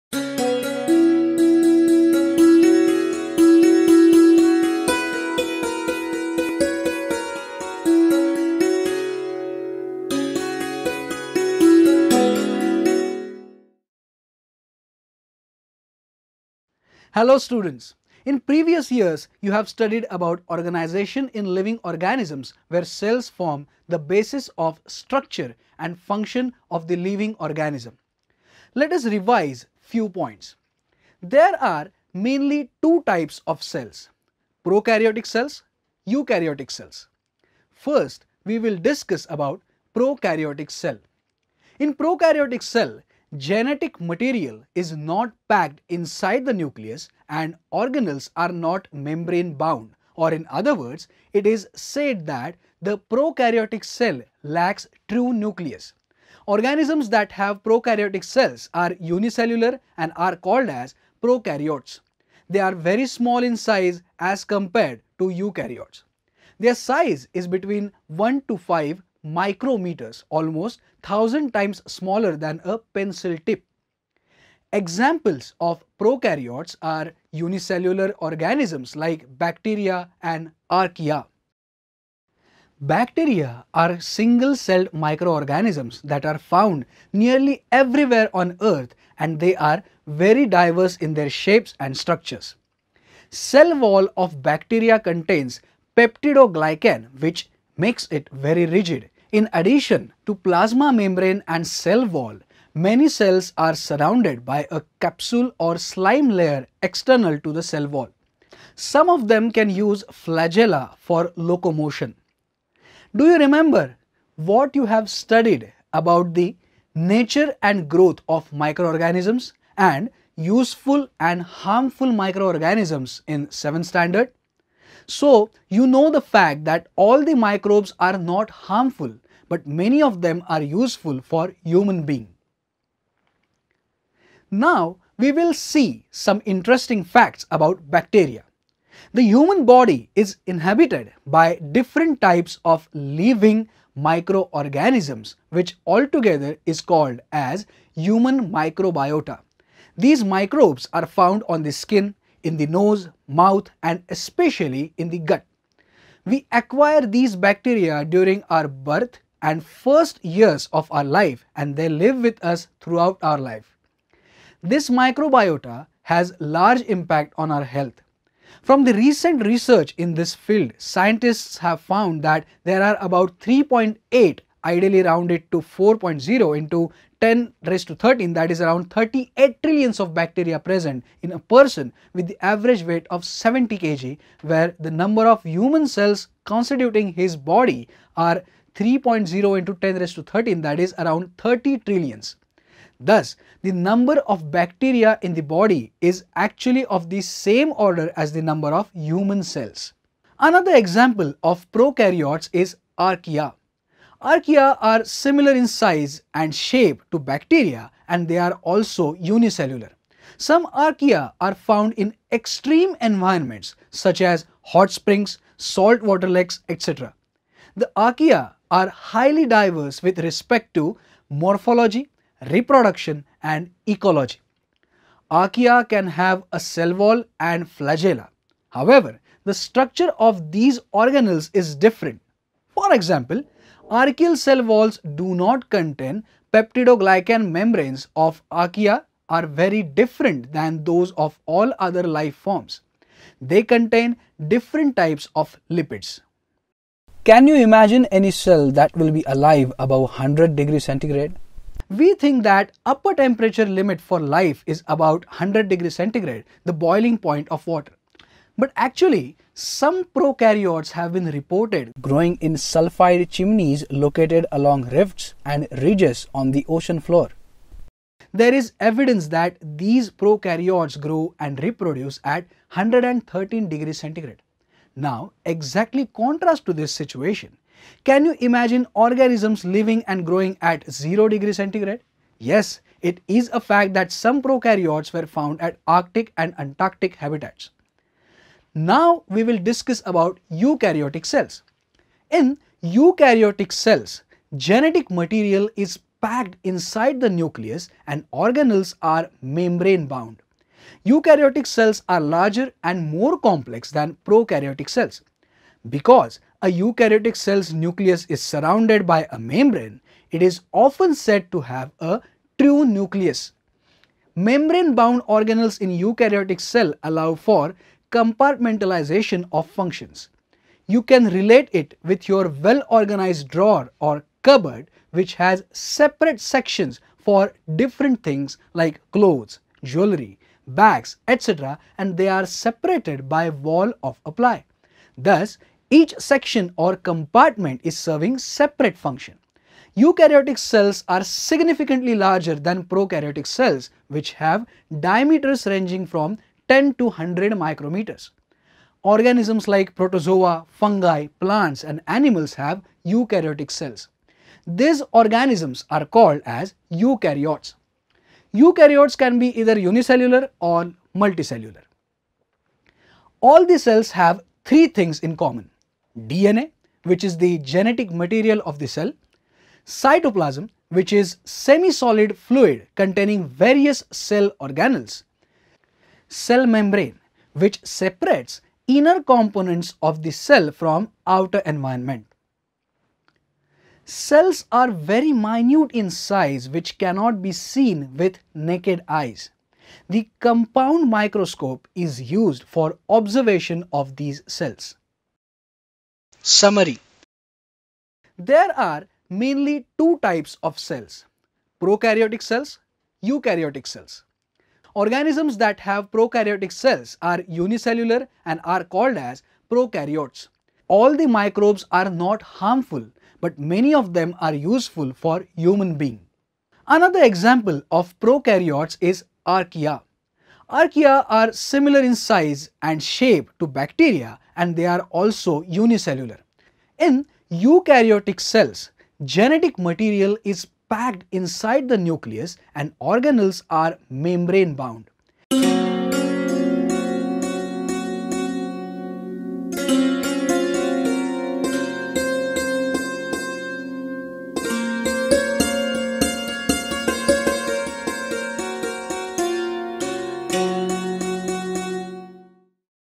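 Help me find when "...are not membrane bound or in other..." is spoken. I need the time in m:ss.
0:48.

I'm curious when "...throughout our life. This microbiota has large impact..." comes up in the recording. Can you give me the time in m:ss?
2:42.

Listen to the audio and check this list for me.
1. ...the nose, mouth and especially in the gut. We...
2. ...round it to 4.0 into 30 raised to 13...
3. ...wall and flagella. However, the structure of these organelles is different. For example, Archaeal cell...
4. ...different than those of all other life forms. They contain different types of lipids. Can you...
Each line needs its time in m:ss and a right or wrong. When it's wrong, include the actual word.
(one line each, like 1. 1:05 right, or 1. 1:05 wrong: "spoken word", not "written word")
1. 2:32 right
2. 2:55 wrong: "10", not "30"
3. 3:46 right
4. 3:59 right.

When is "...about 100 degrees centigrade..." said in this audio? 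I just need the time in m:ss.
4:14.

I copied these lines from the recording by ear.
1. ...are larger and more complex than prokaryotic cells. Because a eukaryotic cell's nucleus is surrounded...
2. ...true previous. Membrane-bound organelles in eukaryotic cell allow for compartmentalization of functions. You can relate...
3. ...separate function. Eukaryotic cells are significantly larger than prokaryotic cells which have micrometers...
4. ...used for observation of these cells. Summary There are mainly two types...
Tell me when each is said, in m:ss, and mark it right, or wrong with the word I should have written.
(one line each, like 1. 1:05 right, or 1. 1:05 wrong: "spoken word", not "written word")
1. 5:02 right
2. 5:12 wrong: "nucleus", not "previous"
3. 5:38 wrong: "diameters", not "micrometers"
4. 6:32 right.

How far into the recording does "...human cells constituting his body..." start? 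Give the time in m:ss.
3:05.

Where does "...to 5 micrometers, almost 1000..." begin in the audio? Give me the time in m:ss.
1:08.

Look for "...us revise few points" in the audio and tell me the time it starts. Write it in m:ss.
0:28.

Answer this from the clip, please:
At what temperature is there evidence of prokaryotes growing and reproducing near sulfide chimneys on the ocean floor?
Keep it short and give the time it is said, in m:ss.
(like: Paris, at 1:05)
113 degrees centigrade, at 4:32.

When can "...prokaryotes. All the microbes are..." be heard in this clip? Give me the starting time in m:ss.
6:49.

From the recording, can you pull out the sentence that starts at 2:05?
So you know the fact that all the microbes are not harmful, but many of them are useful for human being.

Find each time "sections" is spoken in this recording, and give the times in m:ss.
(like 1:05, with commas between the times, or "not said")
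5:26, 5:36.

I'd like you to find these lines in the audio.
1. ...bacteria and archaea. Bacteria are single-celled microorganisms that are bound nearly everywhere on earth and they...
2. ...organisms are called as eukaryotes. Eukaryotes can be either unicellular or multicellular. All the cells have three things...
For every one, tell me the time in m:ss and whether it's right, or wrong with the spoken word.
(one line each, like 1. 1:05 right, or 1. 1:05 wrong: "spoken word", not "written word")
1. 1:19 wrong: "found", not "bound"
2. 5:55 right.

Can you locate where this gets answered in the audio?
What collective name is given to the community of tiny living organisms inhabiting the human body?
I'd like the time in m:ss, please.
2:27.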